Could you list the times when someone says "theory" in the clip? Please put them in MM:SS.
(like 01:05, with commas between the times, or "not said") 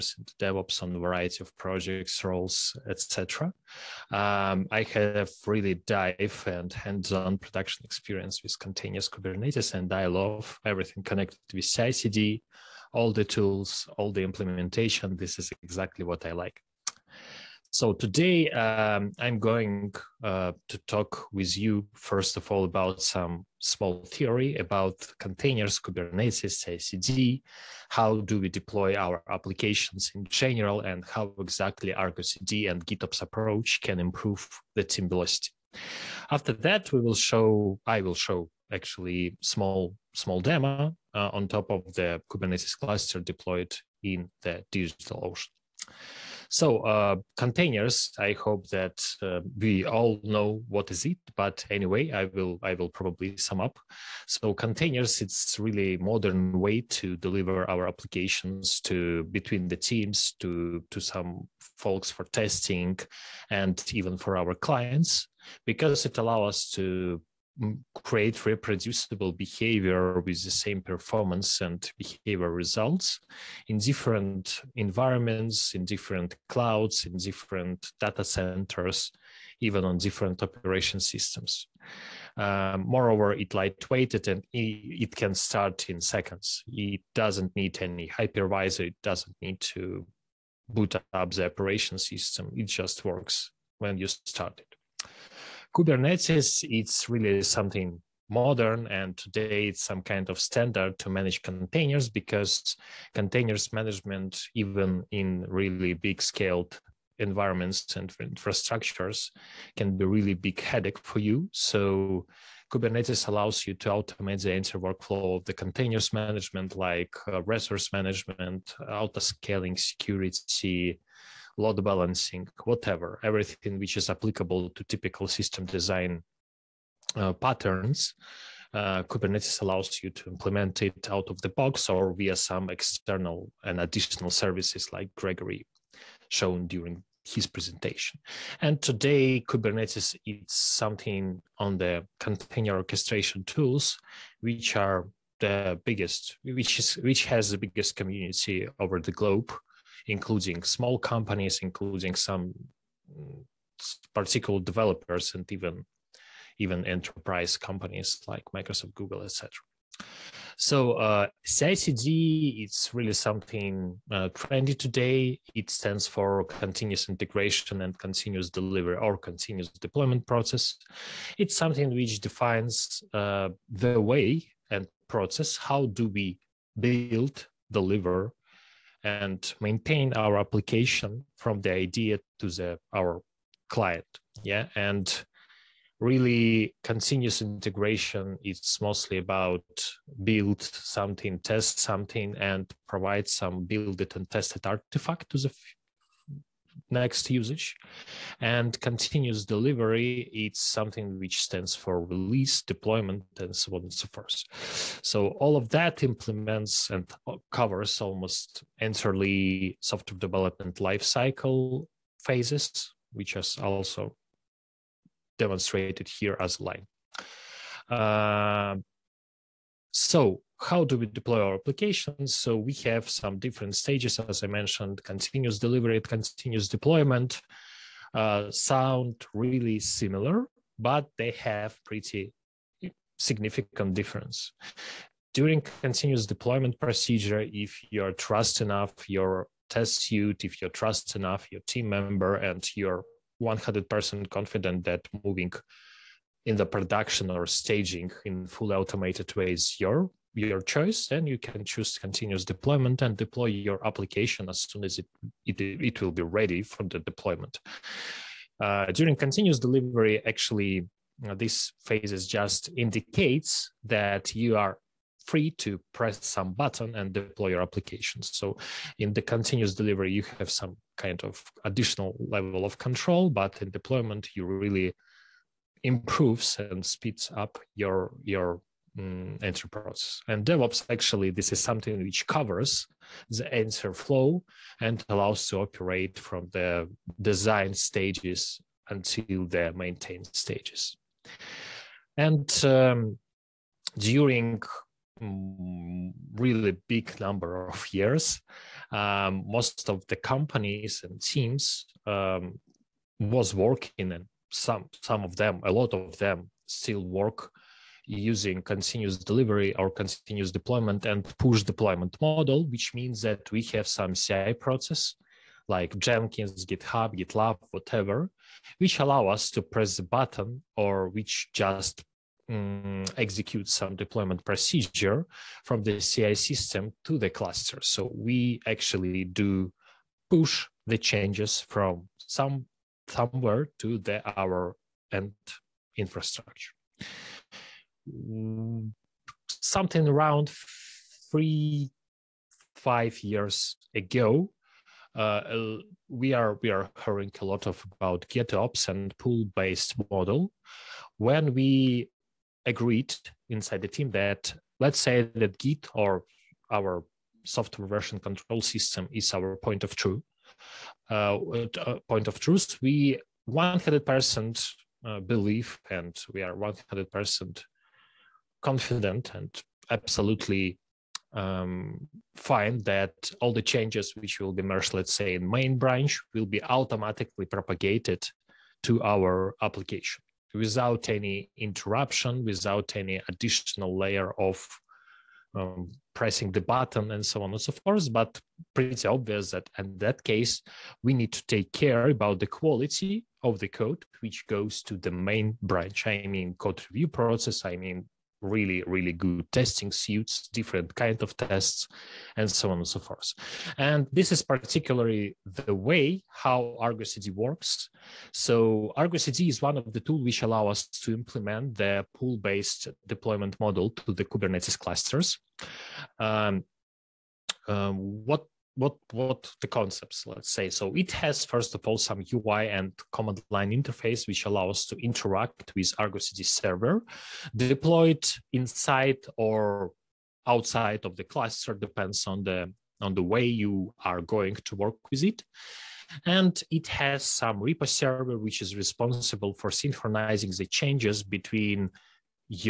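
00:24.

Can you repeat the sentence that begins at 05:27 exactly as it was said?
So we actually do push the changes from some somewhere to the our end infrastructure.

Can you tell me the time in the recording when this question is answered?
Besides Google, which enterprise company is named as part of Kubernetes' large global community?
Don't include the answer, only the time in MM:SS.
02:38.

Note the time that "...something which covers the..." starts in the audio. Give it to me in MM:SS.
04:41.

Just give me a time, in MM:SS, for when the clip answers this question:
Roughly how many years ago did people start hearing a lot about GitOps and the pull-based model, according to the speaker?
05:41.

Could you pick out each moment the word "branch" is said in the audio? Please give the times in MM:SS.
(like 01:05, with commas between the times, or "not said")
06:15, 06:35.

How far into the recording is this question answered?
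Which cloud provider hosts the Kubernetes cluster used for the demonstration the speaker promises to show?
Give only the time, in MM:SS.
00:44.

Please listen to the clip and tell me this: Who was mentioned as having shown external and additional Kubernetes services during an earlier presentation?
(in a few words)
Gregory.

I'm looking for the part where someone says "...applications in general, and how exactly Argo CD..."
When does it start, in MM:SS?
00:29.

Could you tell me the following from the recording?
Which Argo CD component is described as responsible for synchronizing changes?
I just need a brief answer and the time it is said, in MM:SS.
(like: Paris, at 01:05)
repo server, at 07:17.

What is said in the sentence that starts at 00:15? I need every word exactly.
This is exactly what I like.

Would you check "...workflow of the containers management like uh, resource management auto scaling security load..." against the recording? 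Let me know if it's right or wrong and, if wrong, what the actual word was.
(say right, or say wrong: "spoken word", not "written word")
right.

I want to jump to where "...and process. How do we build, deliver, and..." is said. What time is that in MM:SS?
02:54.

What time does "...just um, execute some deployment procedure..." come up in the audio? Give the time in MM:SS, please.
05:21.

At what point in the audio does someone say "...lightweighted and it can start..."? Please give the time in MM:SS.
01:23.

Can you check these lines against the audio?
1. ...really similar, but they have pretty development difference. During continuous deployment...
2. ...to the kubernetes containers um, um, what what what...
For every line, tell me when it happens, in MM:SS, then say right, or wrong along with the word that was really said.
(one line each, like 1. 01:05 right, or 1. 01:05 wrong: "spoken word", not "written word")
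1. 03:49 wrong: "significant", not "development"
2. 06:53 wrong: "clusters", not "containers".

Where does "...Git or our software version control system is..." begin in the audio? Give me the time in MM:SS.
05:55.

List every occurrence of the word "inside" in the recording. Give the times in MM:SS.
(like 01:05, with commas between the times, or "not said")
05:53, 07:08.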